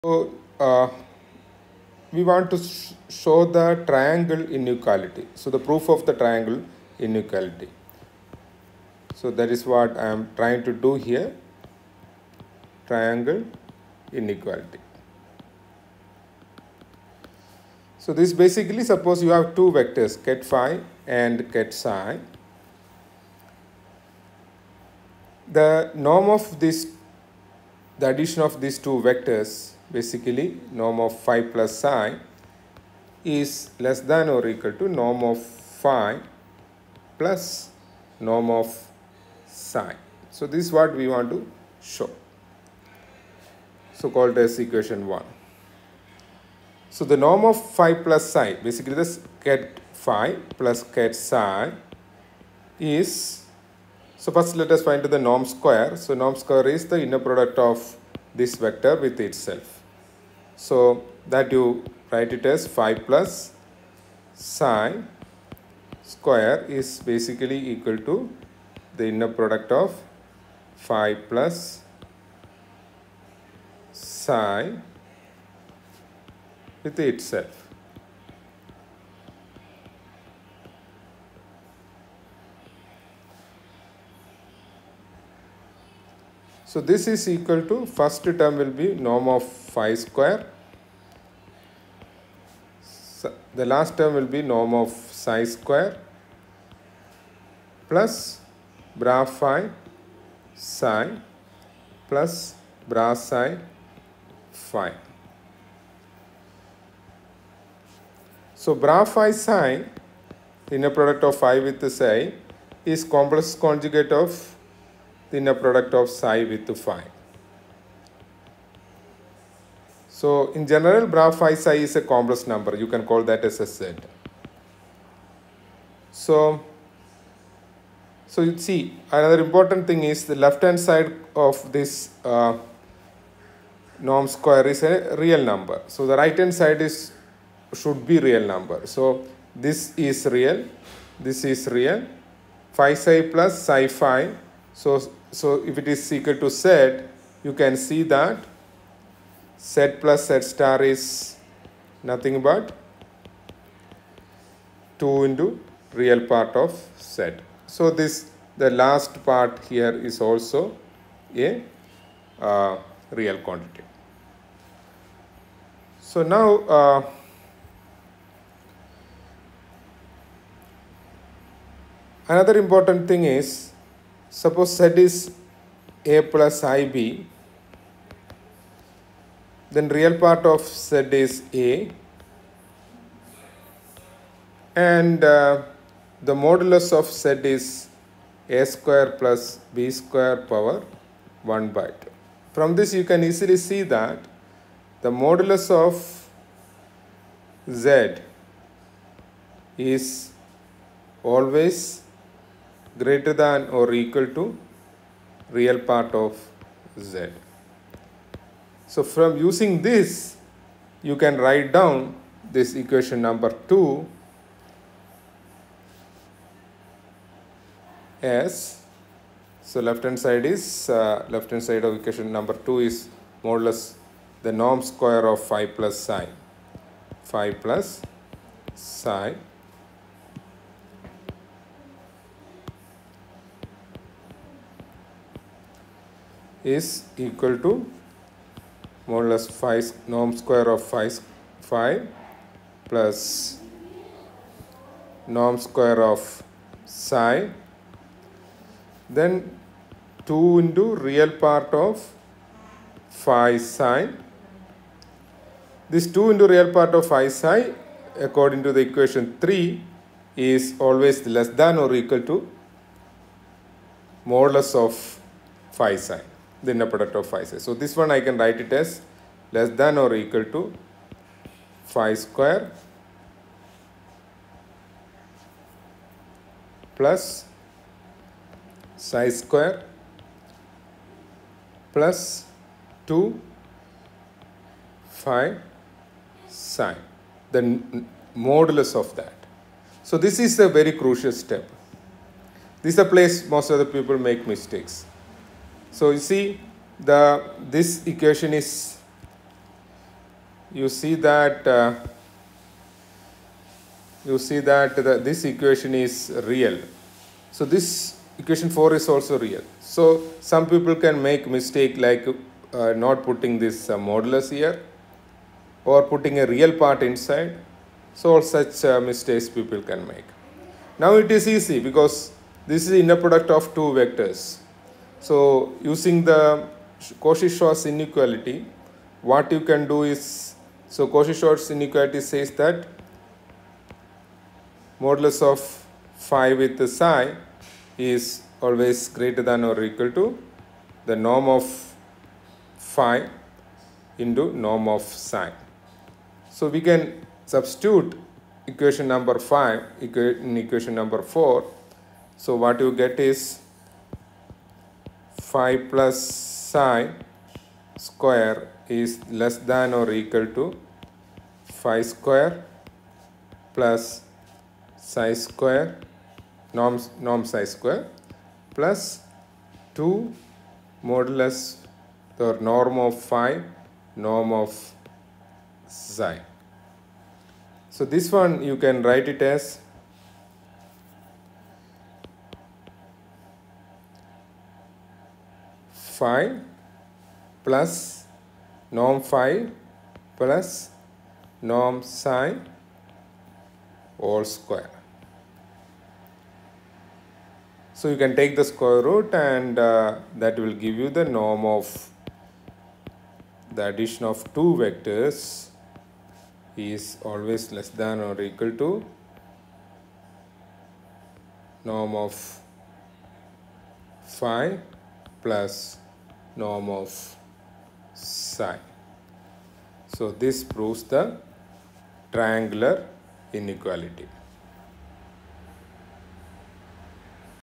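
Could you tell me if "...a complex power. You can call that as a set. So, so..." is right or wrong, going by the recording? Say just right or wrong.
wrong.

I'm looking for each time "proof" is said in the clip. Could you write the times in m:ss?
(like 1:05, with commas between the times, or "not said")
0:05.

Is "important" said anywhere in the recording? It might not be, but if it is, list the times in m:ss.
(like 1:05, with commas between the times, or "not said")
2:09, 2:52.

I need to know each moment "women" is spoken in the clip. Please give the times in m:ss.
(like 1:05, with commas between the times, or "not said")
not said.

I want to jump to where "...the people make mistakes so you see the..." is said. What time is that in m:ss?
4:53.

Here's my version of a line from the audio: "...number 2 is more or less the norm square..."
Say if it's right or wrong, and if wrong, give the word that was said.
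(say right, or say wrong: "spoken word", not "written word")
right.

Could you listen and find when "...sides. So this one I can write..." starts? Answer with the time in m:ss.
4:27.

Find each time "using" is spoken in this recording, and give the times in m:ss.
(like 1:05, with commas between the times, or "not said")
3:29, 5:25.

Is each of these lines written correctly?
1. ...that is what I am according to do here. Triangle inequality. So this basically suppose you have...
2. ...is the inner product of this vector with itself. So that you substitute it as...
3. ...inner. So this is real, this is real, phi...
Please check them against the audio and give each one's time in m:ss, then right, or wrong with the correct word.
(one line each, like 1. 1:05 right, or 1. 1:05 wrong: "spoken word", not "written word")
1. 0:09 wrong: "trying", not "according"
2. 0:56 wrong: "write", not "substitute"
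3. 2:18 wrong: "number", not "inner".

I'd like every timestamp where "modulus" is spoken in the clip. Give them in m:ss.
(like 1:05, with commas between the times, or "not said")
3:06, 3:15, 4:24, 4:48, 5:13, 5:34, 6:11.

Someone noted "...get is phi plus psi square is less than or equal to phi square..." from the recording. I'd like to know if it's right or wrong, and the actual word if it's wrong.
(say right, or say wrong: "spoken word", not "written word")
right.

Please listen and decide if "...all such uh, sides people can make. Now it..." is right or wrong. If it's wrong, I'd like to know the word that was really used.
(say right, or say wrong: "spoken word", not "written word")
wrong: "mistakes", not "sides".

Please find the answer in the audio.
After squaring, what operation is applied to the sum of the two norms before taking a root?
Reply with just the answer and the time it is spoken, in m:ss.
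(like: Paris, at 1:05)
all square, at 6:34.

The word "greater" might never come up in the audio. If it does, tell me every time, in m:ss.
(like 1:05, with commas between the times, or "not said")
3:22, 5:39.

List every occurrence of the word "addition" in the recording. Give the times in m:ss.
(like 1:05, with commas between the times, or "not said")
0:28, 6:43.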